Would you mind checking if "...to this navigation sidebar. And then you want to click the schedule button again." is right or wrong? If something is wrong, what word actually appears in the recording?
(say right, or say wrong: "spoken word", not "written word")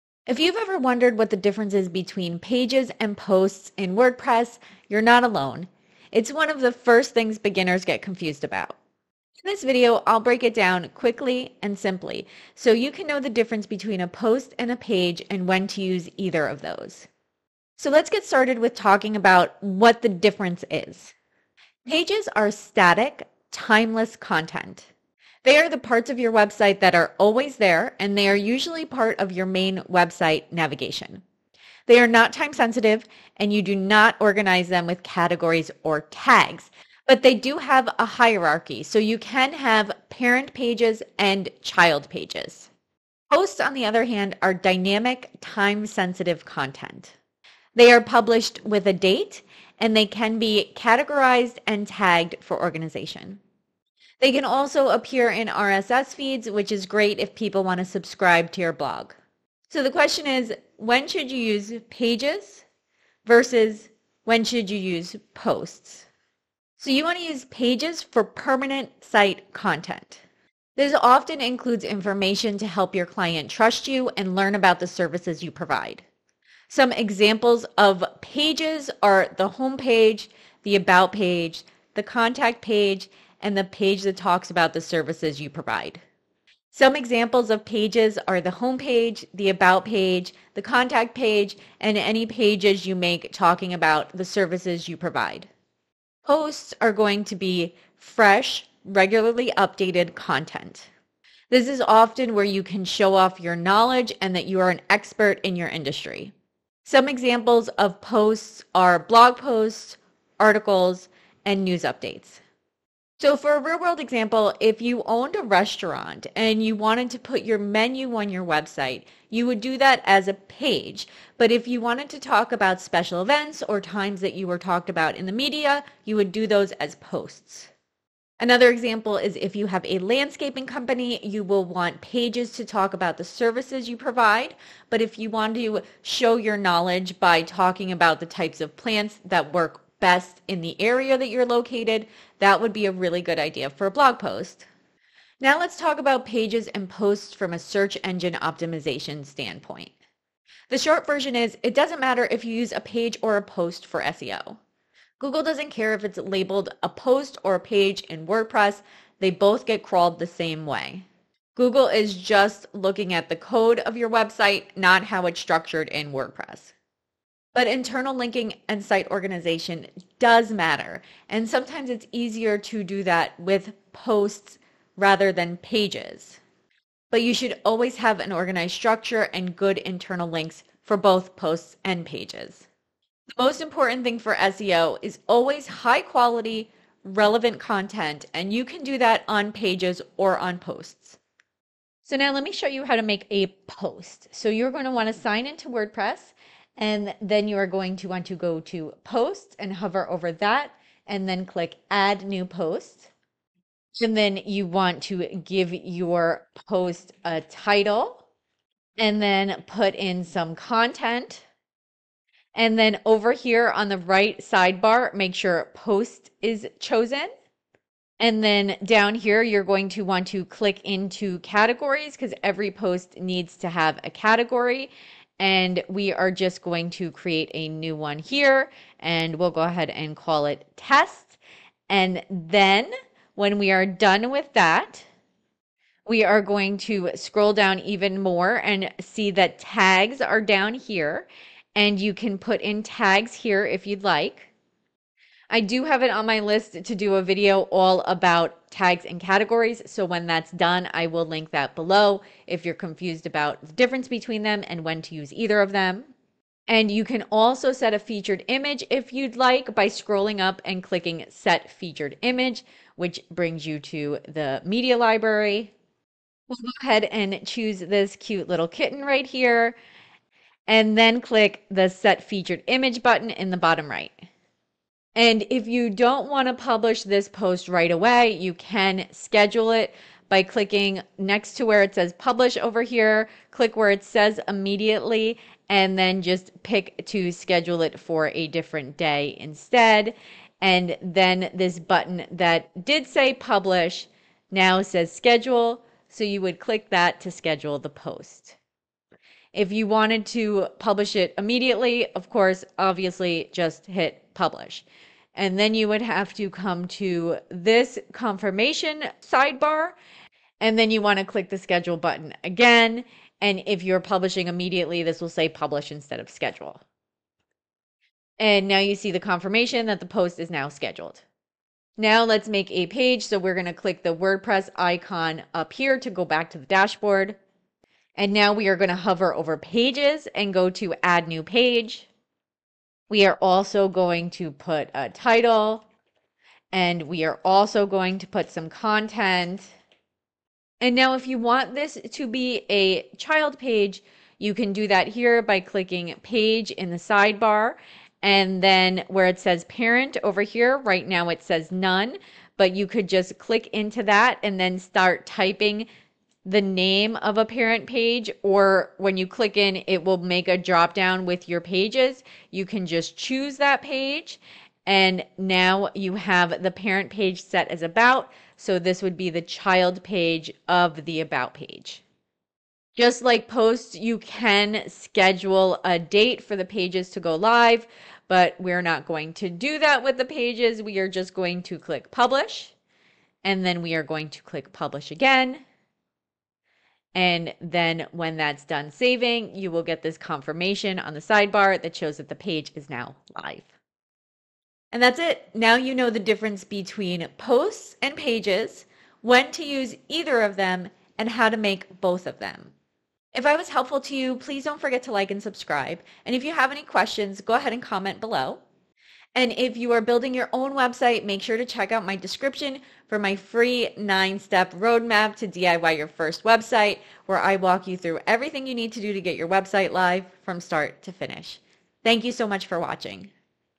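wrong: "confirmation", not "navigation".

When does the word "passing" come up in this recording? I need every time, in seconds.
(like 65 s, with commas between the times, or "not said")
not said.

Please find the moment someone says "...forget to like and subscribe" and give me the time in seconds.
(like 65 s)
404 s.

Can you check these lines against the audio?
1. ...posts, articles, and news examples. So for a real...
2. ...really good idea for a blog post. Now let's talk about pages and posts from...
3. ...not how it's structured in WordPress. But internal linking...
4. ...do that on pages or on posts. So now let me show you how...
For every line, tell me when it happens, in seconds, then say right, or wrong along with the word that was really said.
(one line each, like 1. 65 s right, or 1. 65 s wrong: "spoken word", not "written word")
1. 109 s wrong: "updates", not "examples"
2. 142 s right
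3. 164 s right
4. 188 s right.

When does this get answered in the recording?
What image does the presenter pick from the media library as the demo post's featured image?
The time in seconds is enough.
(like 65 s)
268 s.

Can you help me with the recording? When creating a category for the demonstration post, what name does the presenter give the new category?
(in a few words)
test.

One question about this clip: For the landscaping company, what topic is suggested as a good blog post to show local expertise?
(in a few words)
types of plants.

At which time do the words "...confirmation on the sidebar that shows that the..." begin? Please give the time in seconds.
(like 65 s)
390 s.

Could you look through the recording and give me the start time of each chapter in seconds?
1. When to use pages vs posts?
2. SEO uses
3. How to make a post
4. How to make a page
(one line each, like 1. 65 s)
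1. 59 s
2. 144 s
3. 191 s
4. 321 s.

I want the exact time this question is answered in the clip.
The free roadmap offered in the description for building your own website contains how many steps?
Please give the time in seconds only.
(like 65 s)
413 s.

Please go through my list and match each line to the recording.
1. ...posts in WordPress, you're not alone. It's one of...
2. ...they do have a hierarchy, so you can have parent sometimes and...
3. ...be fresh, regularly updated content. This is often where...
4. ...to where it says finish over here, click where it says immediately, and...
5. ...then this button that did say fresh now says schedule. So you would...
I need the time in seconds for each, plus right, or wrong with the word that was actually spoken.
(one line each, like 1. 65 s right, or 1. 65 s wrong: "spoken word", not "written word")
1. 3 s right
2. 37 s wrong: "pages", not "sometimes"
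3. 97 s right
4. 281 s wrong: "publish", not "finish"
5. 291 s wrong: "publish", not "fresh".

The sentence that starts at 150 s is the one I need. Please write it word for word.
The short version is it doesn't matter if you use a page or a post for SEO.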